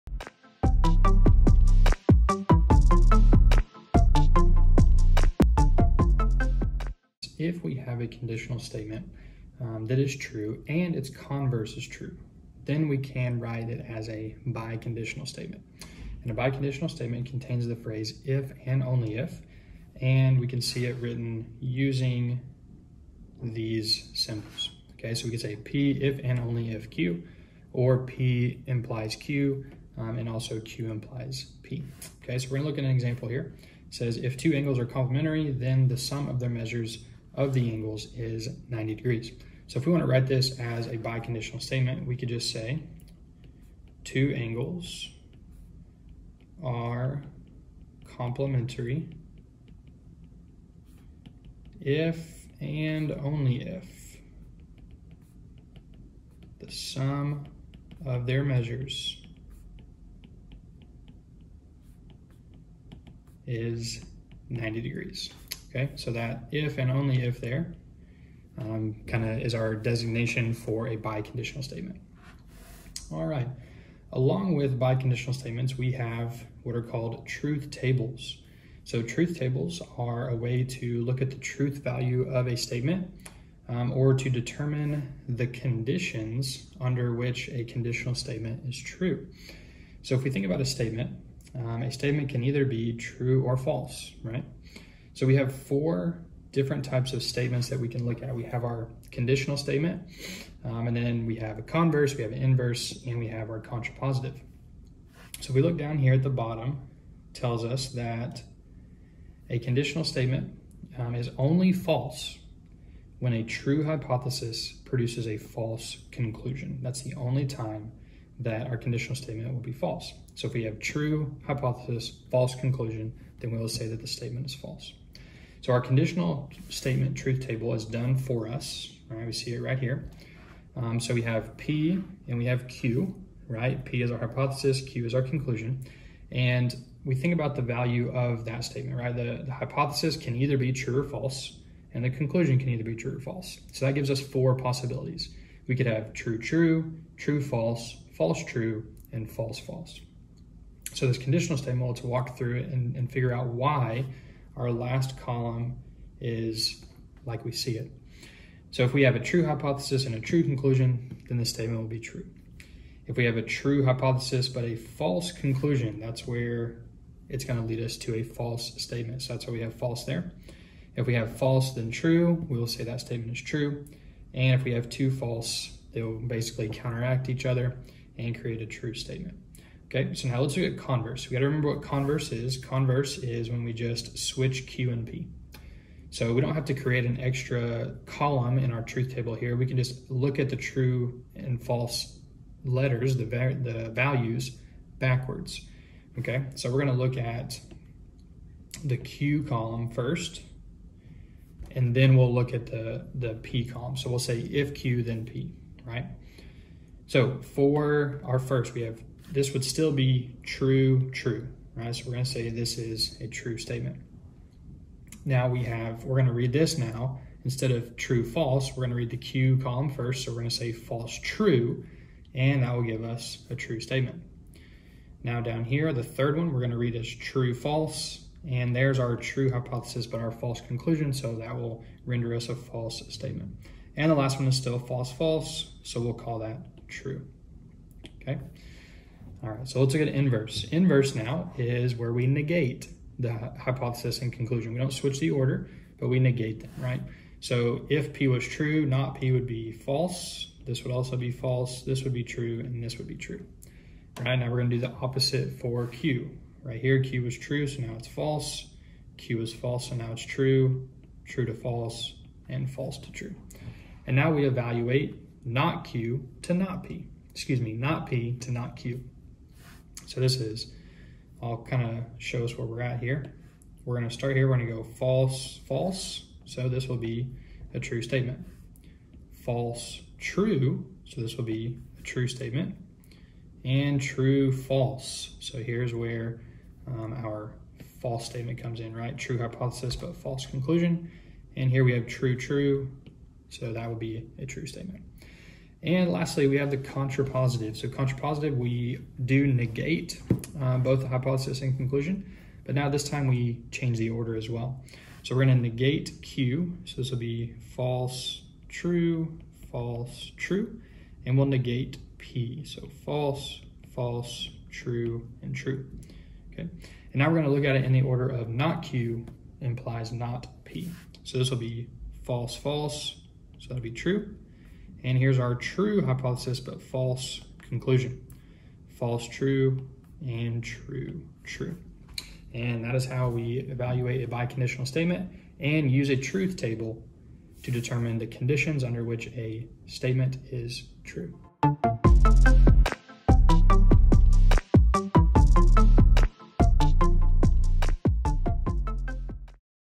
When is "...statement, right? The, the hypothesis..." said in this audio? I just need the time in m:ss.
2:18.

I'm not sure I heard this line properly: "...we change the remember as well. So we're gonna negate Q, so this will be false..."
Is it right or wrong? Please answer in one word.
wrong.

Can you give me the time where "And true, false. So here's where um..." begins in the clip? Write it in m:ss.
4:43.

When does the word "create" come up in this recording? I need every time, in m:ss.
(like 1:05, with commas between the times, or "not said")
2:58, 3:06.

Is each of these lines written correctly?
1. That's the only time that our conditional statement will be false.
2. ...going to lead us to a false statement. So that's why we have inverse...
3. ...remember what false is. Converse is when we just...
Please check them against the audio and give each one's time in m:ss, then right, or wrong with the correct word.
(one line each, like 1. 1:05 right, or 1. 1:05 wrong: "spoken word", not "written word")
1. 1:56 right
2. 2:47 wrong: "false", not "inverse"
3. 3:01 wrong: "converse", not "false".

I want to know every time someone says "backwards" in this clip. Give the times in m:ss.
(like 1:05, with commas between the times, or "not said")
3:14.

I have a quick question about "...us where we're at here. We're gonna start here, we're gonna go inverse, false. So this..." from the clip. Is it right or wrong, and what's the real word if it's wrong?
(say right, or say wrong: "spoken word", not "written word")
wrong: "false", not "inverse".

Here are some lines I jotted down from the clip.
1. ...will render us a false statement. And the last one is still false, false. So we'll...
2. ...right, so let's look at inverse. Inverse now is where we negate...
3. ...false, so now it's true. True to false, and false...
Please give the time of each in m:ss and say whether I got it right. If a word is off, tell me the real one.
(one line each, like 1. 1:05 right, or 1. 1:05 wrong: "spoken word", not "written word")
1. 3:51 right
2. 3:59 right
3. 4:19 right.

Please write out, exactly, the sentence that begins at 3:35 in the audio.
Now we have, we're gonna read this now.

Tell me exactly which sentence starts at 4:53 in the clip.
So that would be a true statement.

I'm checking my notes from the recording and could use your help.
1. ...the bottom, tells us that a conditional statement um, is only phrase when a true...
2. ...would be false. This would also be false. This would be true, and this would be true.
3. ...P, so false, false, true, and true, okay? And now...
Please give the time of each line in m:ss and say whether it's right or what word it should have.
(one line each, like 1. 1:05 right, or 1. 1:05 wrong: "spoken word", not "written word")
1. 1:46 wrong: "false", not "phrase"
2. 4:09 right
3. 5:12 right.